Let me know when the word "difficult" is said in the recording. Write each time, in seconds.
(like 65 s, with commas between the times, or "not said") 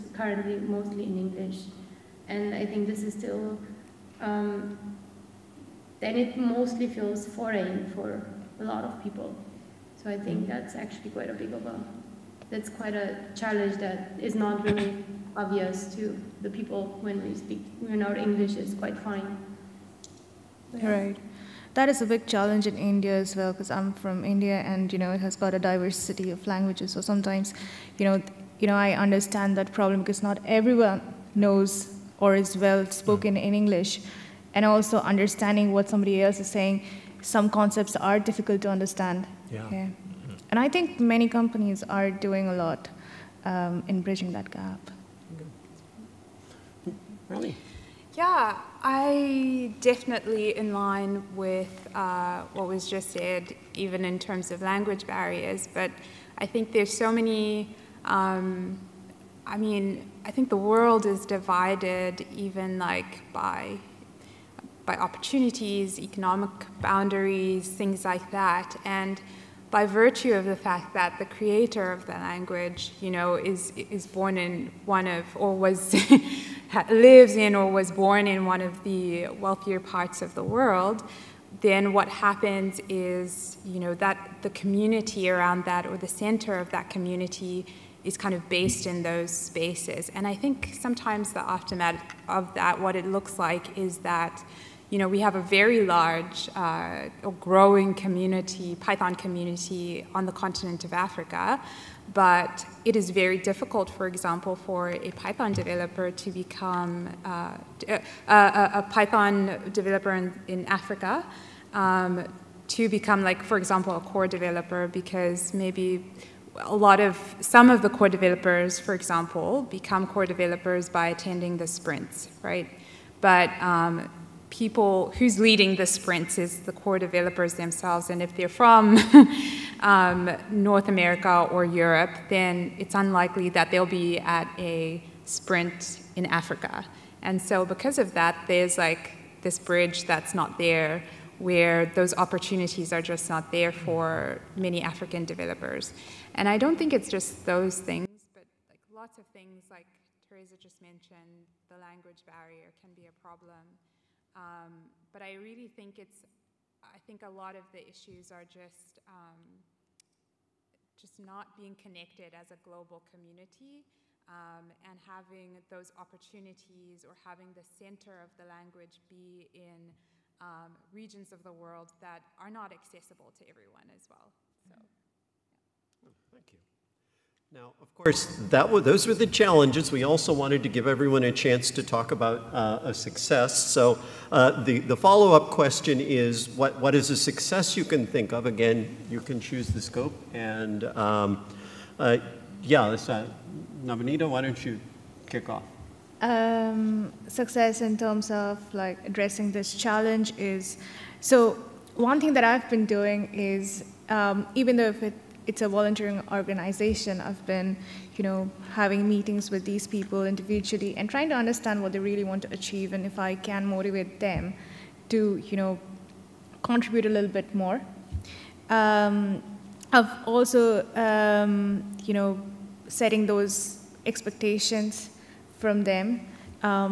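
38 s, 103 s.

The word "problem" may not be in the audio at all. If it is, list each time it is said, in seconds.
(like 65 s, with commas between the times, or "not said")
29 s, 153 s.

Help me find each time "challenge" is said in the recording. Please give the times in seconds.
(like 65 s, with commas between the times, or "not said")
13 s, 22 s, 179 s, 199 s.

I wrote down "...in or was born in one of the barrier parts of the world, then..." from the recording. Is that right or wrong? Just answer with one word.
wrong.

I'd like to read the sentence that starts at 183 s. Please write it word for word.
So uh, the, the follow-up question is, what, what is a success you can think of?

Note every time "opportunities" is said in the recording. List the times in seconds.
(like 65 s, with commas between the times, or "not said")
64 s, 142 s, 165 s.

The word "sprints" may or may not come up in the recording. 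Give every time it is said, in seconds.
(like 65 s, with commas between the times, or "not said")
121 s, 125 s, 135 s.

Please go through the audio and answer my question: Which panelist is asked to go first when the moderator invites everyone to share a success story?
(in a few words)
Nabanita.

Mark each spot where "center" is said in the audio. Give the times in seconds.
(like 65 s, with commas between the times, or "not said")
86 s, 167 s.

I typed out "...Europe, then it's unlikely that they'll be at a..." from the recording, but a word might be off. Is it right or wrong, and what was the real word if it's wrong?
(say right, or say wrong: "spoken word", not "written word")
right.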